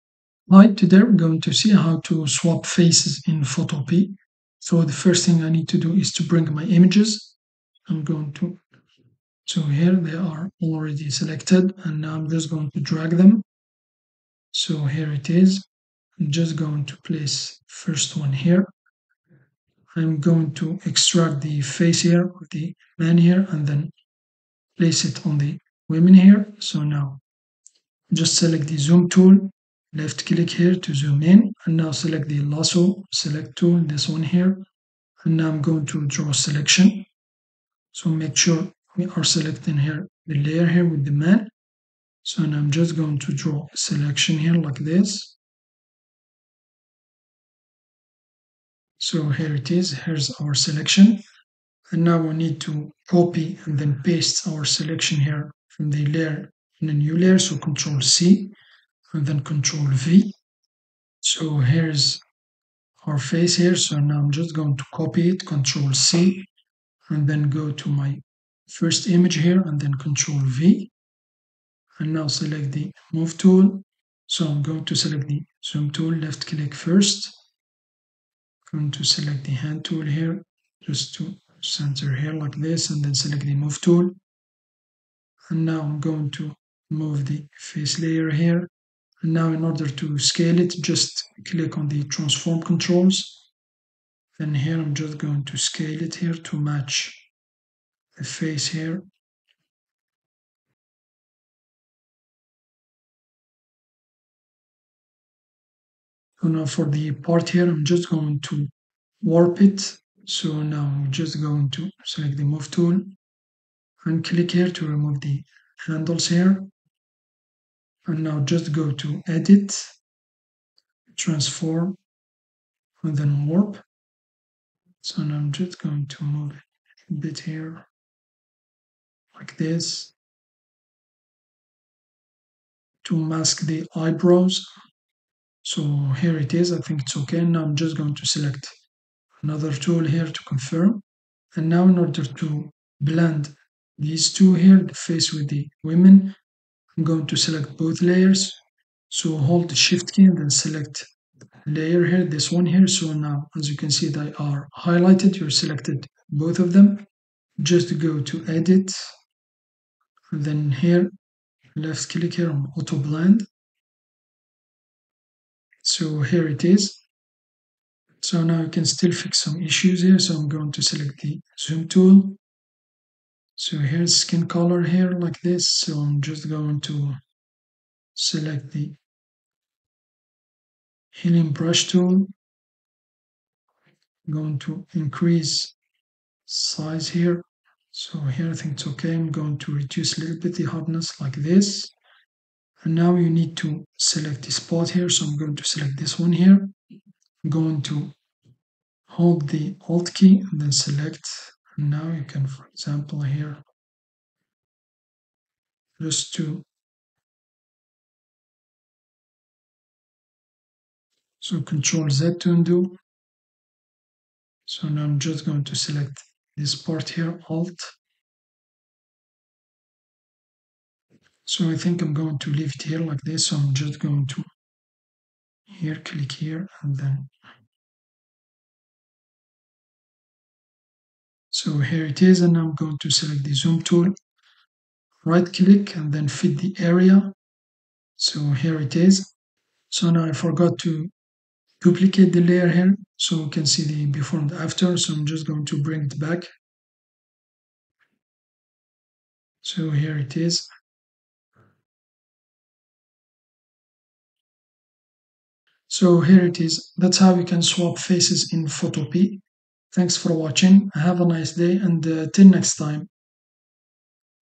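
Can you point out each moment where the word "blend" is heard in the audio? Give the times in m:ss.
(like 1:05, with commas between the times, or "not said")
2:22, 2:42.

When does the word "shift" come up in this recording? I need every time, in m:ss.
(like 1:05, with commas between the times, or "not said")
2:29.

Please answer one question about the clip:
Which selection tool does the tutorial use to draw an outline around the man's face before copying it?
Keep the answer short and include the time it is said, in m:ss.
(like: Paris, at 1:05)
Lasso select tool, at 0:32.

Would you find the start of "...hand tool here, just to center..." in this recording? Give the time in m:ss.
1:19.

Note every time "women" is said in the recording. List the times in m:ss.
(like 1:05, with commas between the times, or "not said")
0:25, 2:25.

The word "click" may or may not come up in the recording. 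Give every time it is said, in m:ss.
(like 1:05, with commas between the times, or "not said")
0:30, 1:16, 1:31, 1:54, 2:42, 3:45, 3:55.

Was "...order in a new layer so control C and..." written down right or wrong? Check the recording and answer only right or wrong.
wrong.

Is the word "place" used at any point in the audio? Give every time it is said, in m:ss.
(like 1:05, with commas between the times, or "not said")
0:16, 0:24.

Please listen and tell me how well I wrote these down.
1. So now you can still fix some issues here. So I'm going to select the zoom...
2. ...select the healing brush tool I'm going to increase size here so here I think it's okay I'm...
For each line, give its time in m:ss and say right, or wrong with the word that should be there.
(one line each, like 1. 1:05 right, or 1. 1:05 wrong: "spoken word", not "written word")
1. 2:48 right
2. 2:58 right.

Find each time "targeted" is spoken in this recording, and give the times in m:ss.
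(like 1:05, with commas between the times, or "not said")
not said.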